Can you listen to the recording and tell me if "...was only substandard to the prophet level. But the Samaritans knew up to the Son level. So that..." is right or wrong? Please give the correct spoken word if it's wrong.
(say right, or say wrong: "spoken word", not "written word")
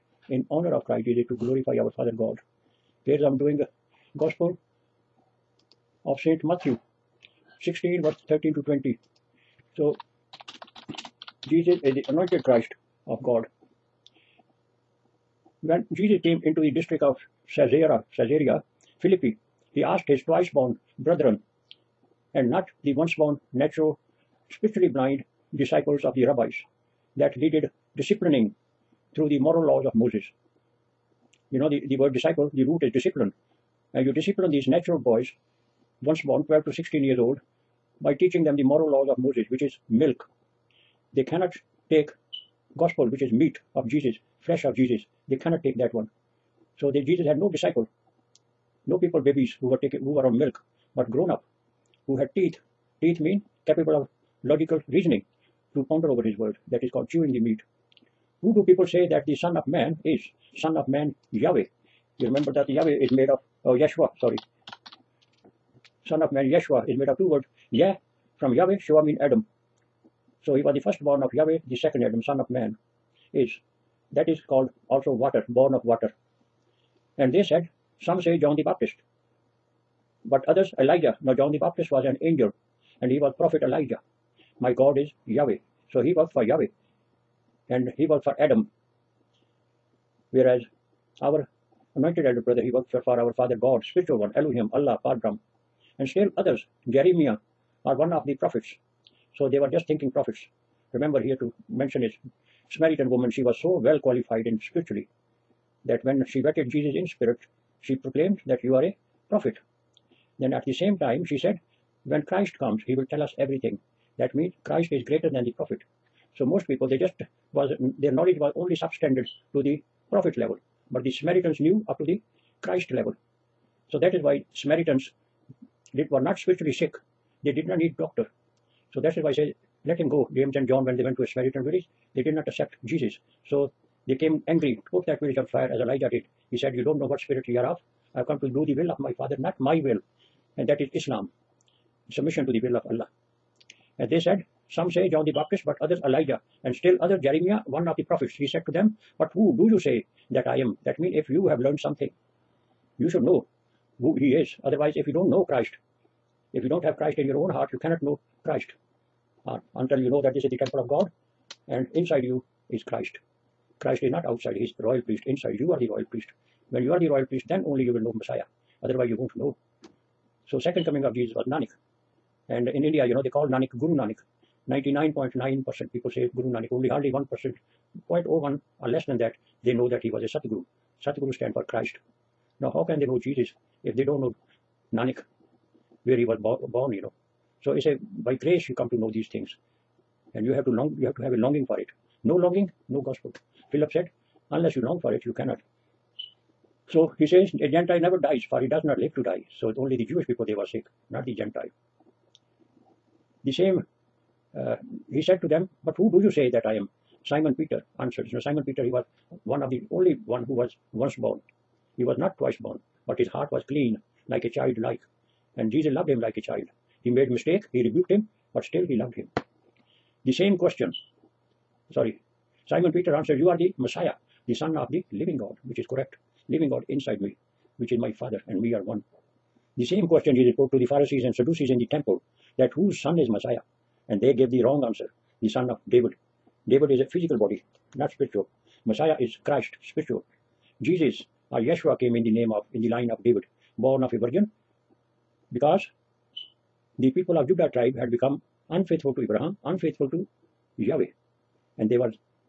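wrong: "Christ", not "Son".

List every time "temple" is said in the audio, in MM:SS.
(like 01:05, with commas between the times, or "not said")
02:40, 03:51.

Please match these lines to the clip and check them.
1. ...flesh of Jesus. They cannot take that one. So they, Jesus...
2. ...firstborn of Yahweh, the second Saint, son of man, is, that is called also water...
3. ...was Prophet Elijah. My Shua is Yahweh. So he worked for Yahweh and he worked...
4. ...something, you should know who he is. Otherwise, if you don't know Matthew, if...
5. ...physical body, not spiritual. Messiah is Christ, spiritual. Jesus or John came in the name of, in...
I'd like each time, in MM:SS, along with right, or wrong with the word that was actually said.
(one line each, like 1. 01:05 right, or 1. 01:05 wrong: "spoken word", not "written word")
1. 00:44 right
2. 01:10 wrong: "Adam", not "Saint"
3. 01:23 wrong: "God", not "Shua"
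4. 02:31 wrong: "Christ", not "Matthew"
5. 03:57 wrong: "Yeshua", not "John".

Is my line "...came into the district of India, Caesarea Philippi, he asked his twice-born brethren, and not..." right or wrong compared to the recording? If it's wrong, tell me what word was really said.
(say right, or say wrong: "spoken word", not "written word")
wrong: "Caesarea", not "India".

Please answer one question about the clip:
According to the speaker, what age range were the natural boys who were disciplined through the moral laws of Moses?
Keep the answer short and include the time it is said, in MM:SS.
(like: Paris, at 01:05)
12 to 16, at 00:36.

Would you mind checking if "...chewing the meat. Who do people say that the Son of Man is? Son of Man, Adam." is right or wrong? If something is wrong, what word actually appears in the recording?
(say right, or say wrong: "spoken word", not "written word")
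wrong: "Yahweh", not "Adam".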